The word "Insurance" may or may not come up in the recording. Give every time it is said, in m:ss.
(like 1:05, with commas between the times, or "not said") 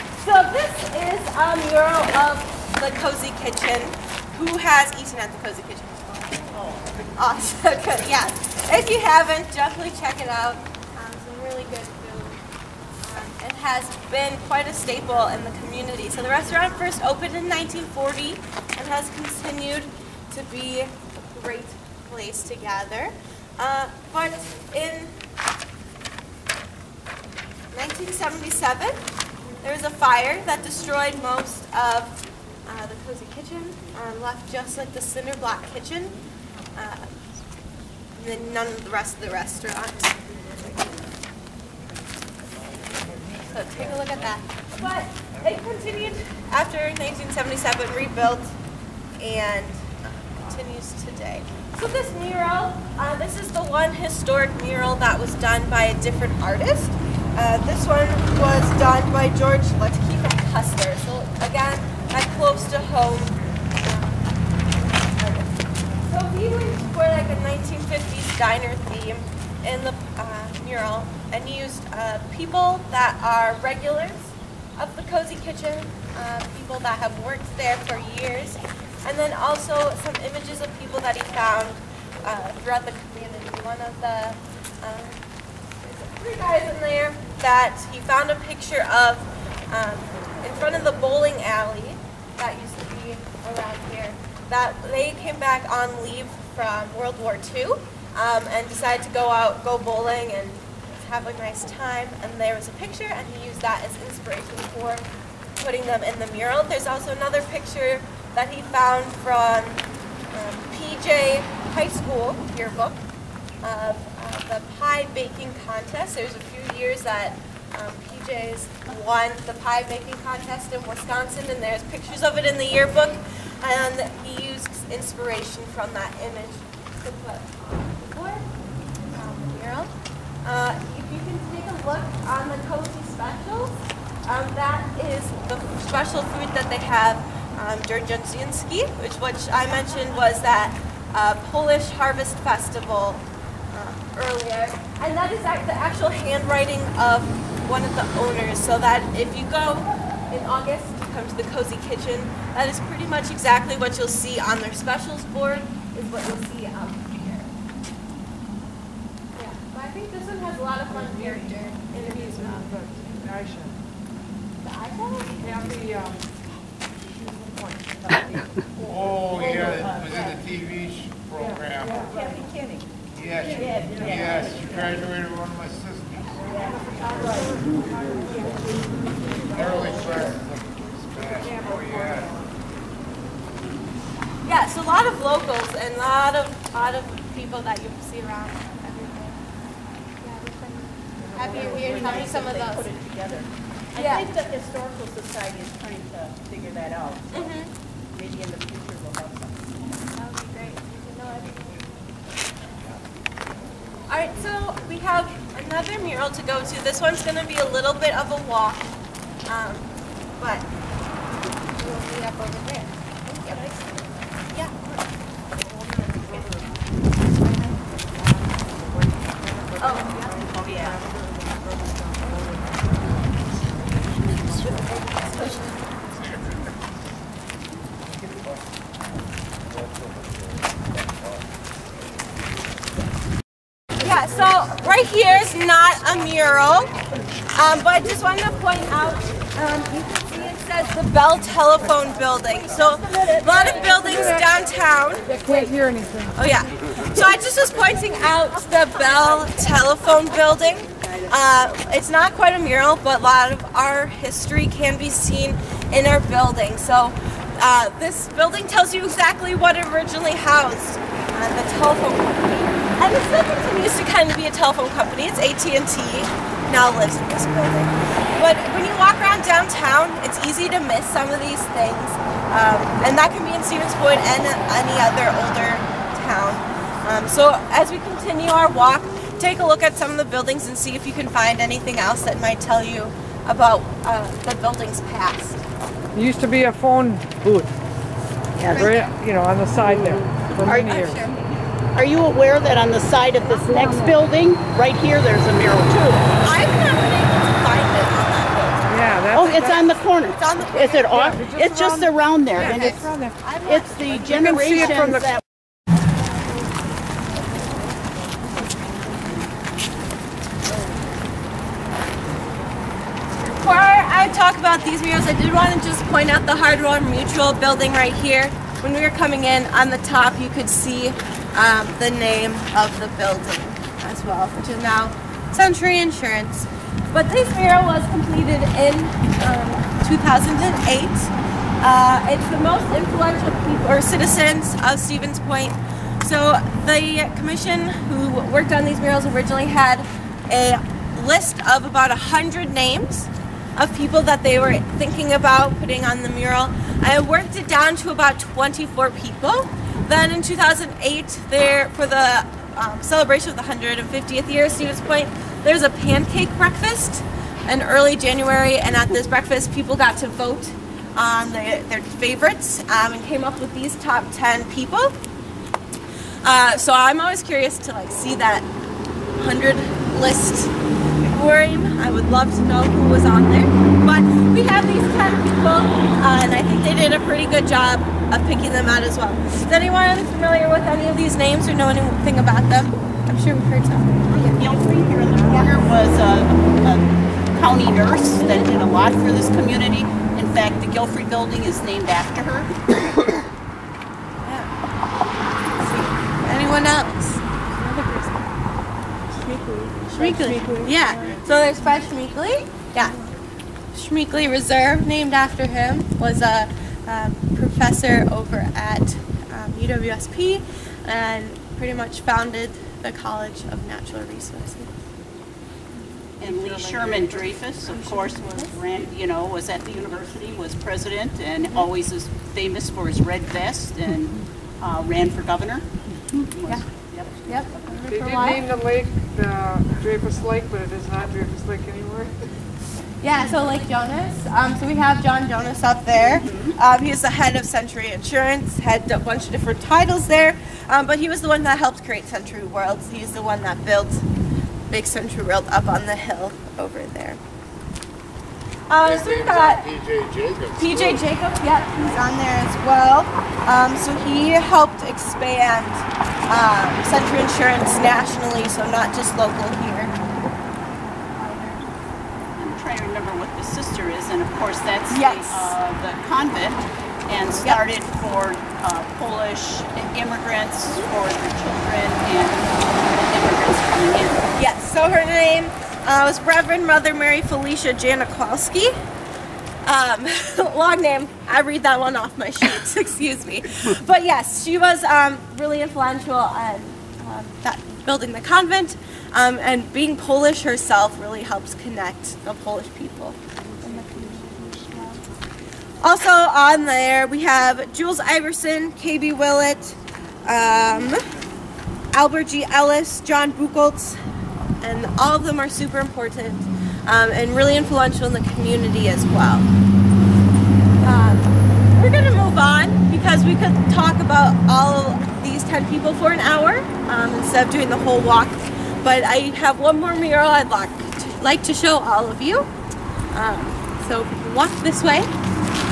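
5:25, 7:18, 7:37.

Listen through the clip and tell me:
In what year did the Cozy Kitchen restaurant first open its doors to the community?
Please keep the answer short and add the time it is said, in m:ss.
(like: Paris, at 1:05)
1940, at 0:17.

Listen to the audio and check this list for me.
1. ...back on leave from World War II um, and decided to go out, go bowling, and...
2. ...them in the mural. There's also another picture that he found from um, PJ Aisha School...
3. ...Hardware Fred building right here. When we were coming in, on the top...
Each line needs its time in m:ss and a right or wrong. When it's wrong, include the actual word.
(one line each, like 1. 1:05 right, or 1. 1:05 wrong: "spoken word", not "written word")
1. 1:35 right
2. 1:45 wrong: "High", not "Aisha"
3. 5:16 wrong: "Mutual", not "Fred".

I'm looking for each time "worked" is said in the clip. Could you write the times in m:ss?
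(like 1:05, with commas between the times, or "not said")
1:17, 5:38, 5:47.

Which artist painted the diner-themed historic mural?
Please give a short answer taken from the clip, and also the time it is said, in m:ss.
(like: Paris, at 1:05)
George Letkeefe Custer, at 0:59.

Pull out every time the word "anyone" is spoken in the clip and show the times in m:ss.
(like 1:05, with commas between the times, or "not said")
6:19, 6:36.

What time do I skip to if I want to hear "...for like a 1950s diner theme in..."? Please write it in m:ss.
1:06.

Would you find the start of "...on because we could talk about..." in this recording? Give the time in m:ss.
8:32.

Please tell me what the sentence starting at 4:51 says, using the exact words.
Are you aware that on the side of this next building, right here, there's a mural too?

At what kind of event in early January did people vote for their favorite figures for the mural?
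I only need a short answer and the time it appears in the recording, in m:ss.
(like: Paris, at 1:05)
Pancake breakfast, at 5:55.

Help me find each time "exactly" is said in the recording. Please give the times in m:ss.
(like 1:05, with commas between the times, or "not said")
2:33, 4:19.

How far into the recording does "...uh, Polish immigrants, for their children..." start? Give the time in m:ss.
7:48.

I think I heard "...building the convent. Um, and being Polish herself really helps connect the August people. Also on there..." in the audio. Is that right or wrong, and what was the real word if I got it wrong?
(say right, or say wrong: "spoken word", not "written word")
wrong: "Polish", not "August".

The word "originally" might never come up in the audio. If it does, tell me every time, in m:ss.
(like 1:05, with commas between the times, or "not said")
4:19, 5:39.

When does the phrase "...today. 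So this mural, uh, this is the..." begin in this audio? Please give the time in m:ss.
0:51.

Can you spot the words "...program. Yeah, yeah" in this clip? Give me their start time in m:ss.
2:51.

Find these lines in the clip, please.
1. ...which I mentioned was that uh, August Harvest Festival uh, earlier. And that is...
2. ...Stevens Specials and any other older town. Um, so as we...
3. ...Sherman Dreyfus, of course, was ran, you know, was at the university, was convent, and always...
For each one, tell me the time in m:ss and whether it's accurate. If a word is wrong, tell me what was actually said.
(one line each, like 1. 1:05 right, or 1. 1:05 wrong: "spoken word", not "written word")
1. 2:19 wrong: "Polish", not "August"
2. 4:33 wrong: "Point", not "Specials"
3. 6:56 wrong: "president", not "convent".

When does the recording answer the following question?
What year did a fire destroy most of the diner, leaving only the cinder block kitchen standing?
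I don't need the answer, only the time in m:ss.
0:24.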